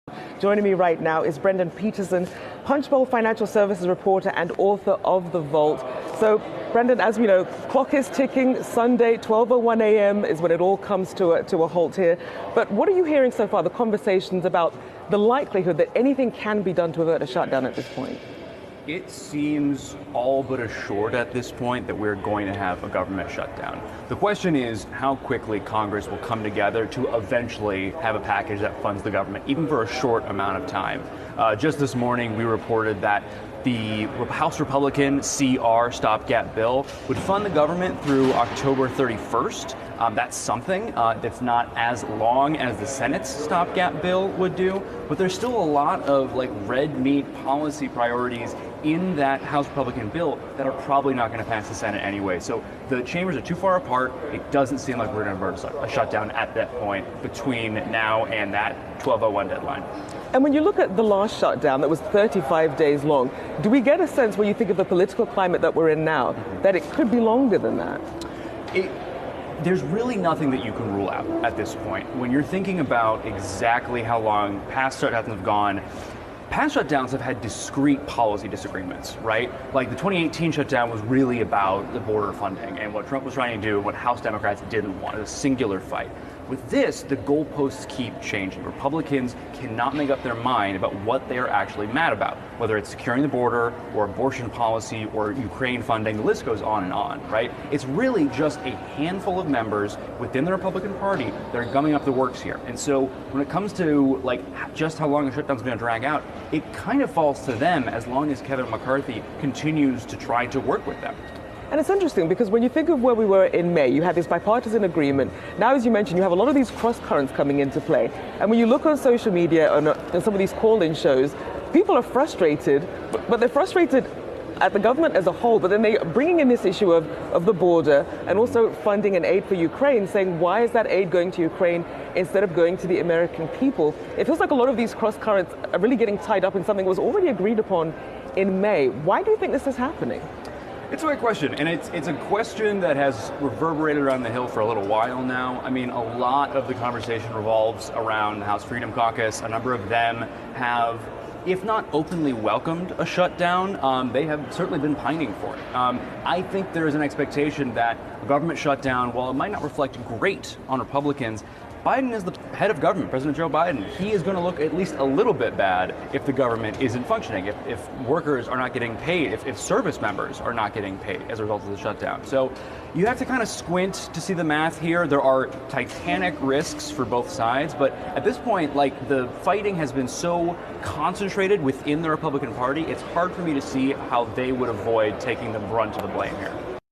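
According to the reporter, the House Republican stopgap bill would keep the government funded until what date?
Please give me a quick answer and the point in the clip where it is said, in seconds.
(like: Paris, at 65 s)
October 31st, at 38 s.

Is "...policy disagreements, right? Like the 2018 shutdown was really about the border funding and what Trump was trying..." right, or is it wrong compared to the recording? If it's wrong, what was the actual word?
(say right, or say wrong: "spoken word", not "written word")
right.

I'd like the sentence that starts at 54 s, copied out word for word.
It doesn't seem like we're going to avert a shutdown at that point between now and that 1201 deadline.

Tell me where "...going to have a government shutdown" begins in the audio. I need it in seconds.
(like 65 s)
22 s.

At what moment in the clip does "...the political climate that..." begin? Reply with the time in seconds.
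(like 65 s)
64 s.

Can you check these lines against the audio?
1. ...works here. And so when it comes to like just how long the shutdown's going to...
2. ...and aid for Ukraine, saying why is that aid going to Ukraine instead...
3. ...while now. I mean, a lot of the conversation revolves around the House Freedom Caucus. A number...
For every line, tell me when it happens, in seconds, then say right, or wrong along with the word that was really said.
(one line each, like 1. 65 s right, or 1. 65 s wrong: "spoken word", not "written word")
1. 102 s right
2. 129 s right
3. 144 s right.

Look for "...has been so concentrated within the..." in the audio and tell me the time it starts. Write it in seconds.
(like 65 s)
179 s.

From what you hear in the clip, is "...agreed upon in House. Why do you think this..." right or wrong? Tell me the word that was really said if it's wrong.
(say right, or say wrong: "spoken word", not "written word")
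wrong: "May", not "House".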